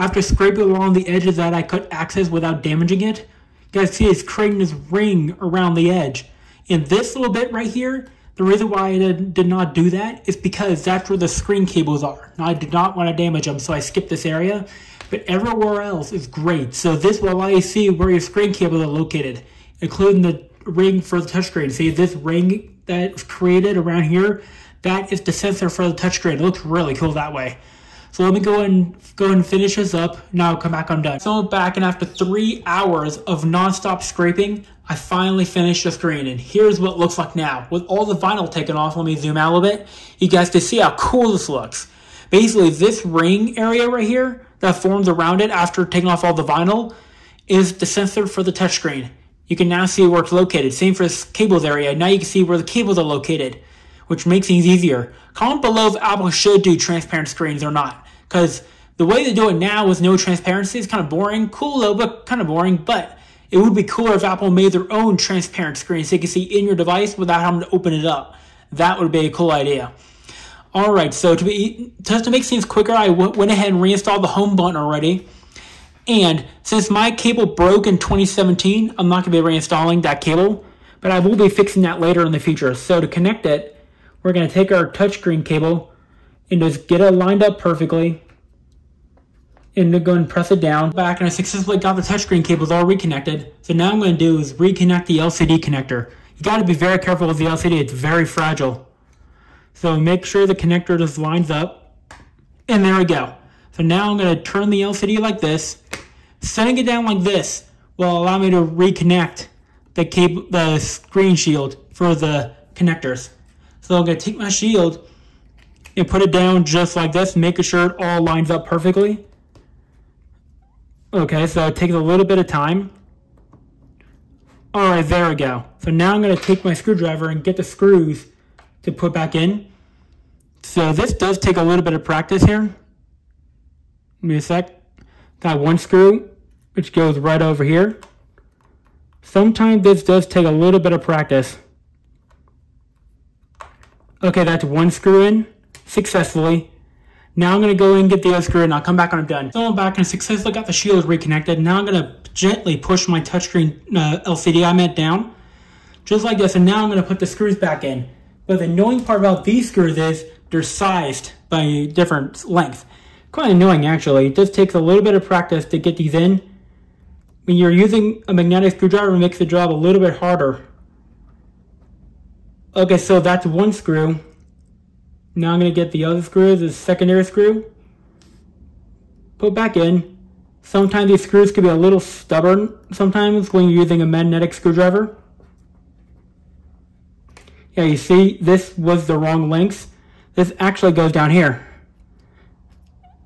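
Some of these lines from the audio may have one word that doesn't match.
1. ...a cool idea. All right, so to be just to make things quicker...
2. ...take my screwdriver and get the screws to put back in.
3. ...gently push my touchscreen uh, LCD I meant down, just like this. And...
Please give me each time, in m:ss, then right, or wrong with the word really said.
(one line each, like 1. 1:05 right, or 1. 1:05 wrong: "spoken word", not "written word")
1. 1:09 right
2. 2:06 right
3. 2:32 right.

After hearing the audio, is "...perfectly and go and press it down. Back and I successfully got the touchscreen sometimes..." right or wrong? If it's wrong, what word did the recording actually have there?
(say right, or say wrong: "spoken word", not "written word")
wrong: "cables", not "sometimes".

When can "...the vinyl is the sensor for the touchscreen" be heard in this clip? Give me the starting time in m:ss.
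0:46.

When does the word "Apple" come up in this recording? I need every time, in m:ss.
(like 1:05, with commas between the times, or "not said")
0:55, 1:04.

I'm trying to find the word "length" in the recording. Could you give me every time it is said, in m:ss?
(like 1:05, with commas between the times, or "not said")
2:42, 3:09.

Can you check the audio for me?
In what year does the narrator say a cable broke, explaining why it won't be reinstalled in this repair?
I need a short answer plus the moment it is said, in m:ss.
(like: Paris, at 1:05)
2017, at 1:17.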